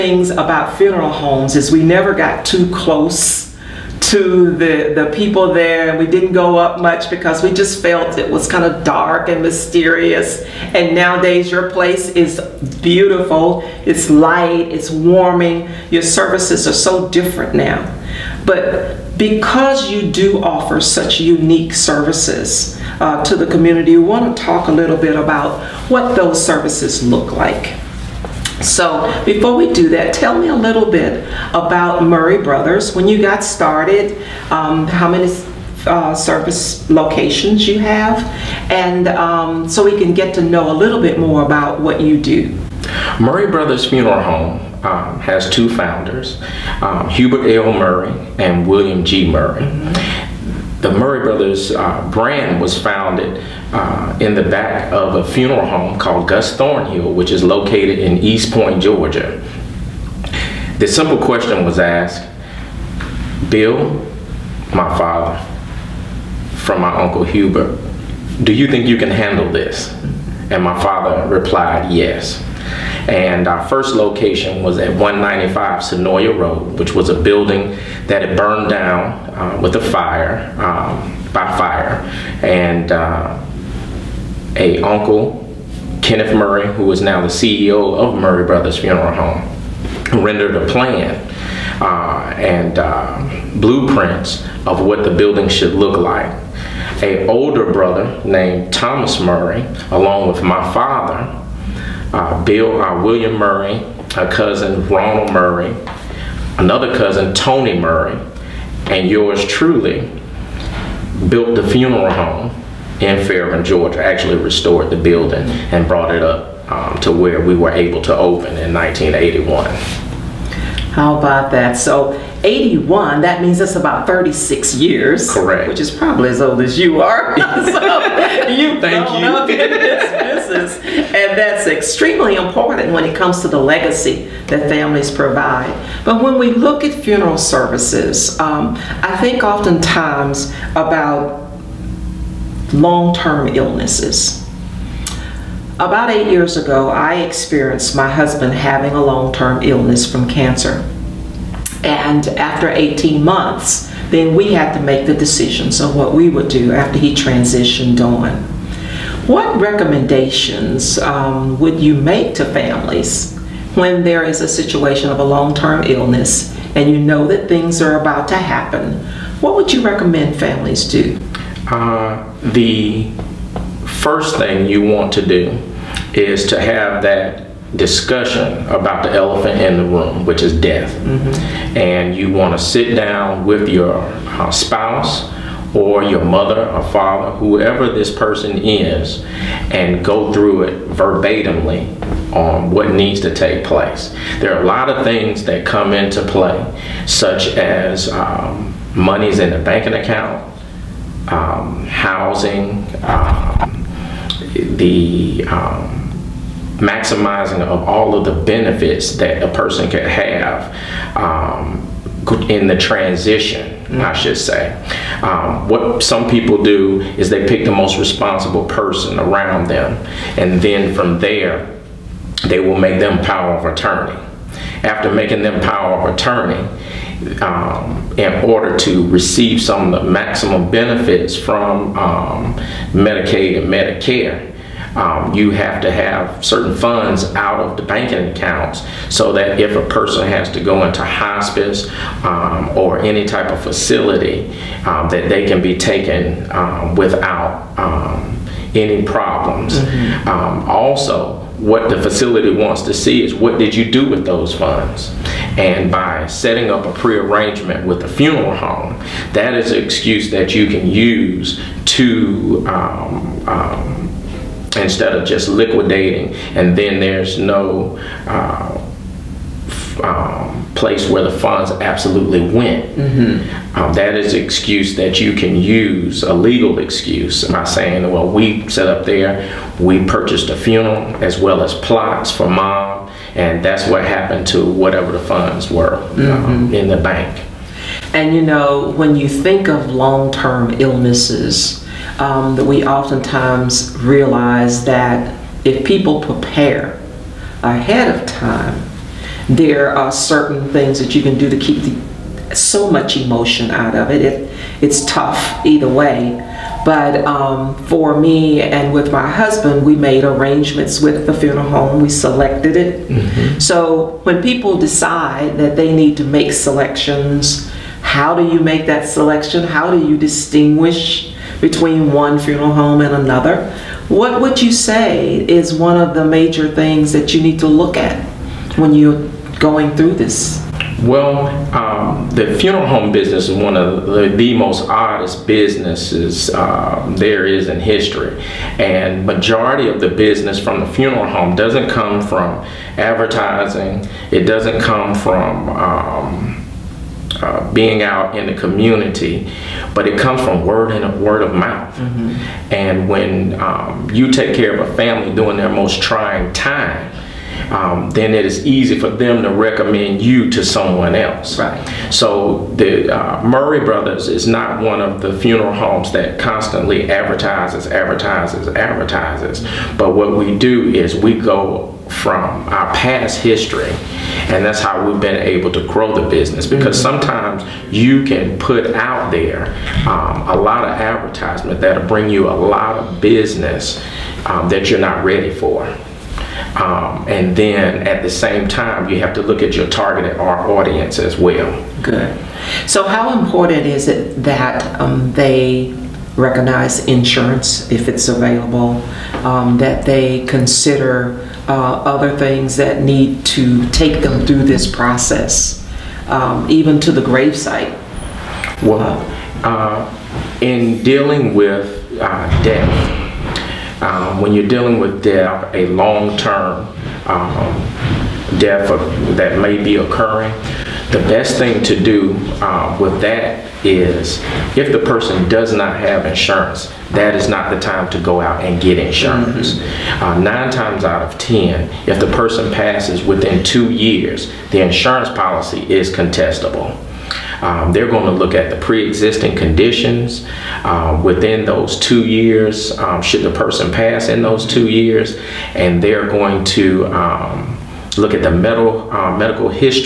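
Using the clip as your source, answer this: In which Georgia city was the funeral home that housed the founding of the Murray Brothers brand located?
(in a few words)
East Point.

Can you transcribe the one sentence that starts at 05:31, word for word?
Well, um, the funeral home business is one of the, the most oddest businesses uh, there is in history.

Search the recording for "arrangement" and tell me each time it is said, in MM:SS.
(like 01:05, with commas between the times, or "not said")
04:16, 05:10.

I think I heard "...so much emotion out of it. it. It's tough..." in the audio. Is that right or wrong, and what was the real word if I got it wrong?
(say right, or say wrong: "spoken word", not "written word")
right.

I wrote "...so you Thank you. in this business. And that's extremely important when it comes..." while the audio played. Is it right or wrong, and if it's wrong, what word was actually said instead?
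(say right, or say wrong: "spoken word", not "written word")
right.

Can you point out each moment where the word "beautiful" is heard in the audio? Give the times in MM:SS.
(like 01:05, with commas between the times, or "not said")
00:12.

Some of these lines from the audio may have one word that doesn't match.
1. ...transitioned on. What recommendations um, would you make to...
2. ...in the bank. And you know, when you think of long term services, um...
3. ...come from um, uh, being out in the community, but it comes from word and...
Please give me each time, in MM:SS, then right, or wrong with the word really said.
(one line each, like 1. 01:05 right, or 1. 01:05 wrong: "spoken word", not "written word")
1. 02:37 right
2. 04:46 wrong: "illnesses", not "services"
3. 05:44 right.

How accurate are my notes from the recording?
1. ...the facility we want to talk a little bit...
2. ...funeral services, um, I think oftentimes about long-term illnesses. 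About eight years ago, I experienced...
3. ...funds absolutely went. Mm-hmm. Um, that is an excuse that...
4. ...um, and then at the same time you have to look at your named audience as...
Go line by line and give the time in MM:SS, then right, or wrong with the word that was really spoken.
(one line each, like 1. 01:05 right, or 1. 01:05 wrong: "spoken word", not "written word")
1. 00:23 wrong: "community", not "facility"
2. 02:17 right
3. 04:31 right
4. 06:26 wrong: "targeted", not "named".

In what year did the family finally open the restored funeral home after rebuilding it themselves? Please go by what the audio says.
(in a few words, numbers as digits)
1981.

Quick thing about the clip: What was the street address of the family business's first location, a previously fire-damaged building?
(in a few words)
195 Senoia Road.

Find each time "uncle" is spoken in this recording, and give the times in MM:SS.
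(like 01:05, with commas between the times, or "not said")
01:06, 01:24.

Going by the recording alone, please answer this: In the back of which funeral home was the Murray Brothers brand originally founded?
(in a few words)
Gus Thornhill.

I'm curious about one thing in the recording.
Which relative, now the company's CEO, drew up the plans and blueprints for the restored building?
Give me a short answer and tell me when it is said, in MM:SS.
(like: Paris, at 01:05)
Kenneth Murray, at 01:26.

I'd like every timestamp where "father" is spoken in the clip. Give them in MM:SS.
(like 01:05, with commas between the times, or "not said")
01:04, 01:10, 01:40, 03:06.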